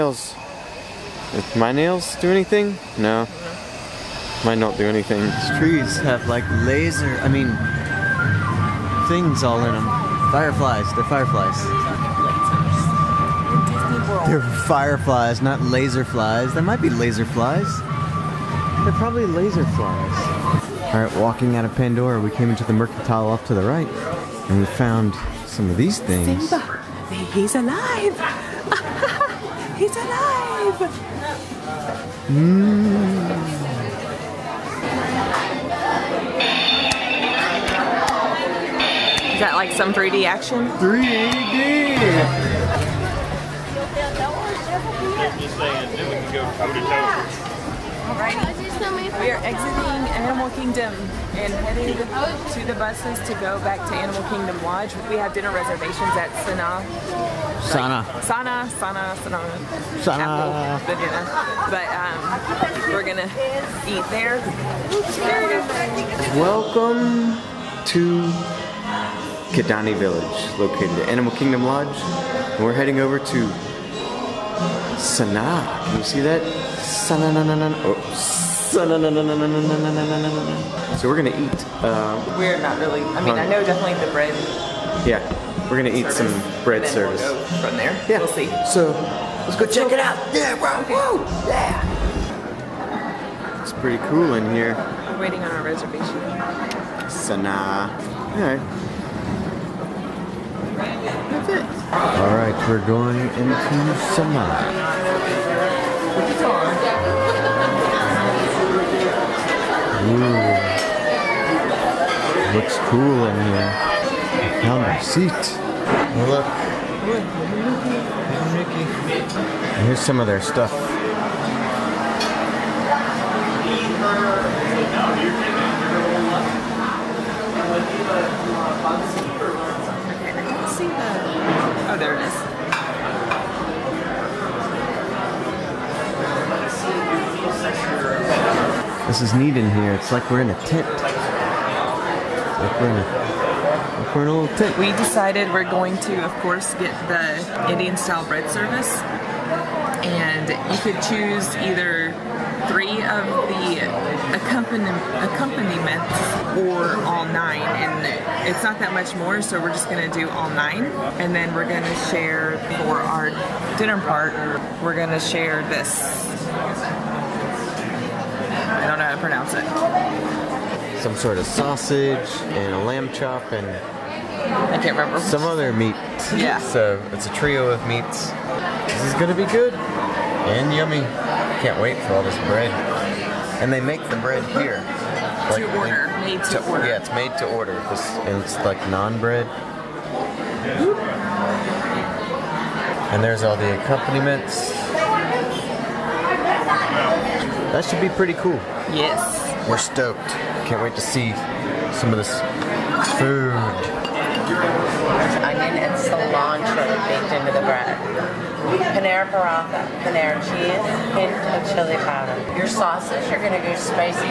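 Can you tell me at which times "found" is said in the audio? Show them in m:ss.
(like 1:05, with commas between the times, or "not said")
0:24, 1:54.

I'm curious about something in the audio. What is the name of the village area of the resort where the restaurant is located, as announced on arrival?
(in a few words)
Kidani Village.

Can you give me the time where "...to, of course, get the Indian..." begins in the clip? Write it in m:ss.
2:25.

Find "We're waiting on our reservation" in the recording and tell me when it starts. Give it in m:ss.
1:35.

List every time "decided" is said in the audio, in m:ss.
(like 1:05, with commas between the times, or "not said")
2:24.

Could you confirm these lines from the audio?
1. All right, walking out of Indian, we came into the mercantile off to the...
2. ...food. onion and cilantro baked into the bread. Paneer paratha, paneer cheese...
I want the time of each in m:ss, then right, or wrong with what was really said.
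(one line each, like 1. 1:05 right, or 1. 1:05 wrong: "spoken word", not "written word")
1. 0:20 wrong: "Pandora", not "Indian"
2. 3:23 right.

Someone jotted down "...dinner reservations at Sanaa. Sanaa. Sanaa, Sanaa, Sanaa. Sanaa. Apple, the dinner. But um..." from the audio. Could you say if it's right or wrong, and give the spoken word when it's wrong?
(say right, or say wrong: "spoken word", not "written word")
right.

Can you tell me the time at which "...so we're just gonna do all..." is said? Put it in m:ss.
2:39.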